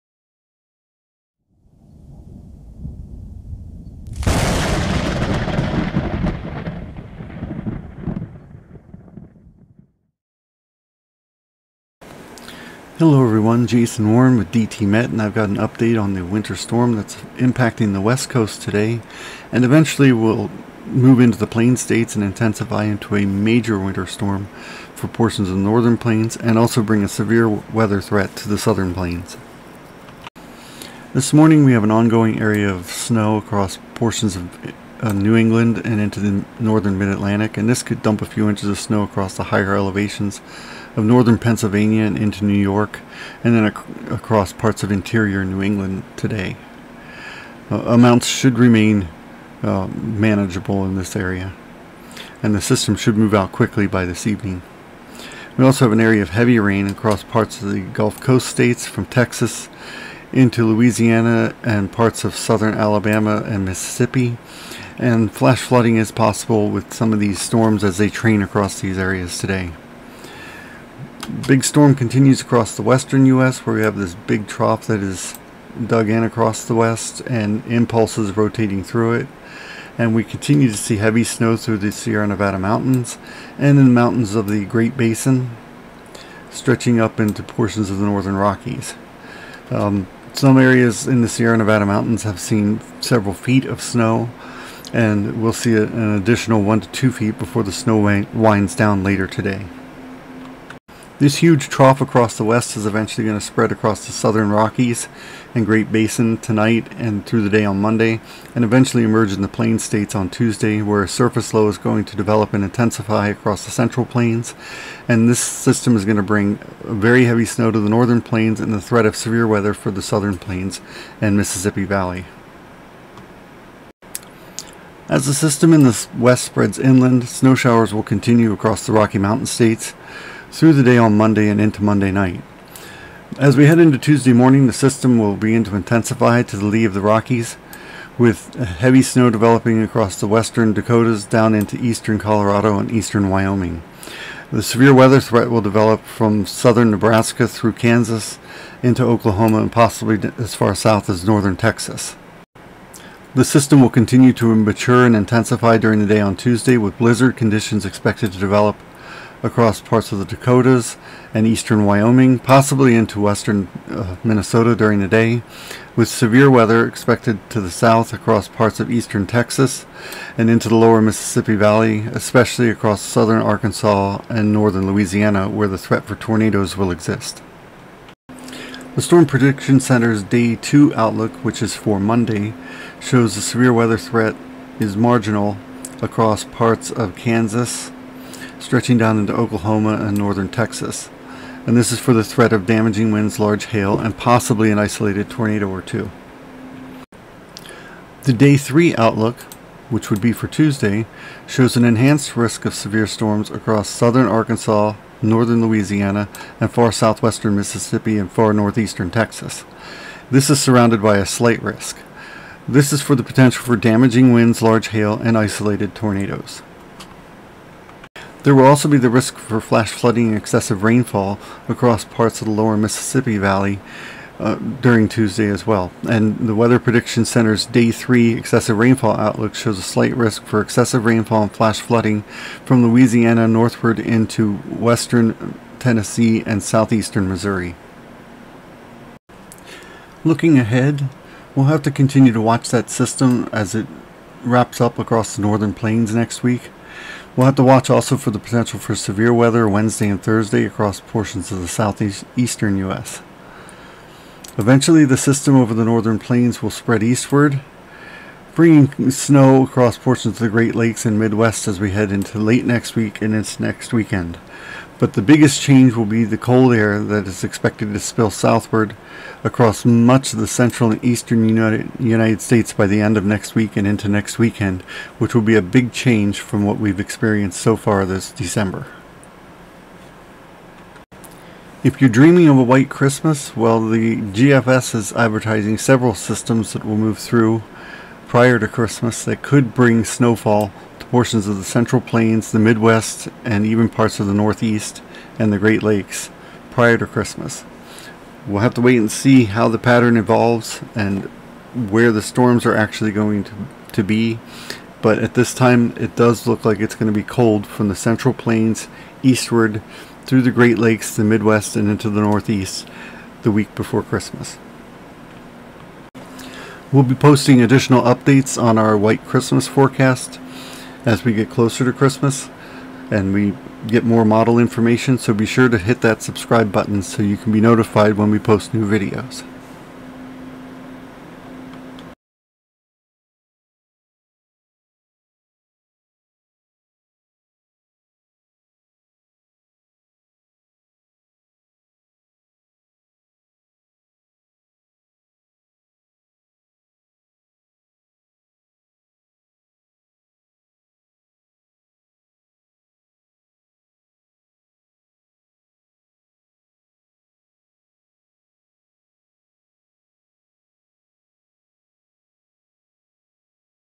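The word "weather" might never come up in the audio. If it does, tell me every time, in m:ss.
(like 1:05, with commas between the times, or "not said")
0:27, 1:59, 2:24, 2:46, 3:03, 3:46, 4:09.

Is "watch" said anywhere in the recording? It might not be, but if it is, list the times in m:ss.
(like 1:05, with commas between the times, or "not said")
4:02, 4:07.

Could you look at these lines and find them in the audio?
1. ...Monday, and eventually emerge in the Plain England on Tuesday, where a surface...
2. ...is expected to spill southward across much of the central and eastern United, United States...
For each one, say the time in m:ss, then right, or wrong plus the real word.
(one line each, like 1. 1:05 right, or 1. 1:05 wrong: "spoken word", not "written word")
1. 1:47 wrong: "States", not "England"
2. 4:27 right.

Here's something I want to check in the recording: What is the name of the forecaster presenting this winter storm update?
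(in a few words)
Jason Warren.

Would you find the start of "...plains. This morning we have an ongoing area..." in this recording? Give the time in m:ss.
0:28.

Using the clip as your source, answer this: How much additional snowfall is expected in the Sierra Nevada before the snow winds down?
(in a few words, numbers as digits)
1 to 2 feet.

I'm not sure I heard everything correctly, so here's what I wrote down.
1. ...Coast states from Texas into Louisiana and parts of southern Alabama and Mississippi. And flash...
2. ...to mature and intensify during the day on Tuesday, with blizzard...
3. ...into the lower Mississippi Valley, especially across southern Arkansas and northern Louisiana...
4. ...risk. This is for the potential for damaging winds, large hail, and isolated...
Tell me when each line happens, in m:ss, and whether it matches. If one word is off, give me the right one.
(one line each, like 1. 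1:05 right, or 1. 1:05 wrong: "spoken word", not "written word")
1. 0:58 right
2. 2:34 right
3. 2:50 right
4. 3:31 right.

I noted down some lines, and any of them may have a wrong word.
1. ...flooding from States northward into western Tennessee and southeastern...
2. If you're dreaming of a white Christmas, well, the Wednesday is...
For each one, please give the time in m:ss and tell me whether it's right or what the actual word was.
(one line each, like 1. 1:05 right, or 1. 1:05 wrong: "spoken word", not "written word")
1. 3:51 wrong: "Louisiana", not "States"
2. 4:41 wrong: "GFS", not "Wednesday".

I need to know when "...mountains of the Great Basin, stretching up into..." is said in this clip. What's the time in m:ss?
1:23.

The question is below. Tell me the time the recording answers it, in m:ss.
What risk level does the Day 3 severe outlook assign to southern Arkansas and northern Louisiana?
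3:21.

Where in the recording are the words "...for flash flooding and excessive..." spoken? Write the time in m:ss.
3:39.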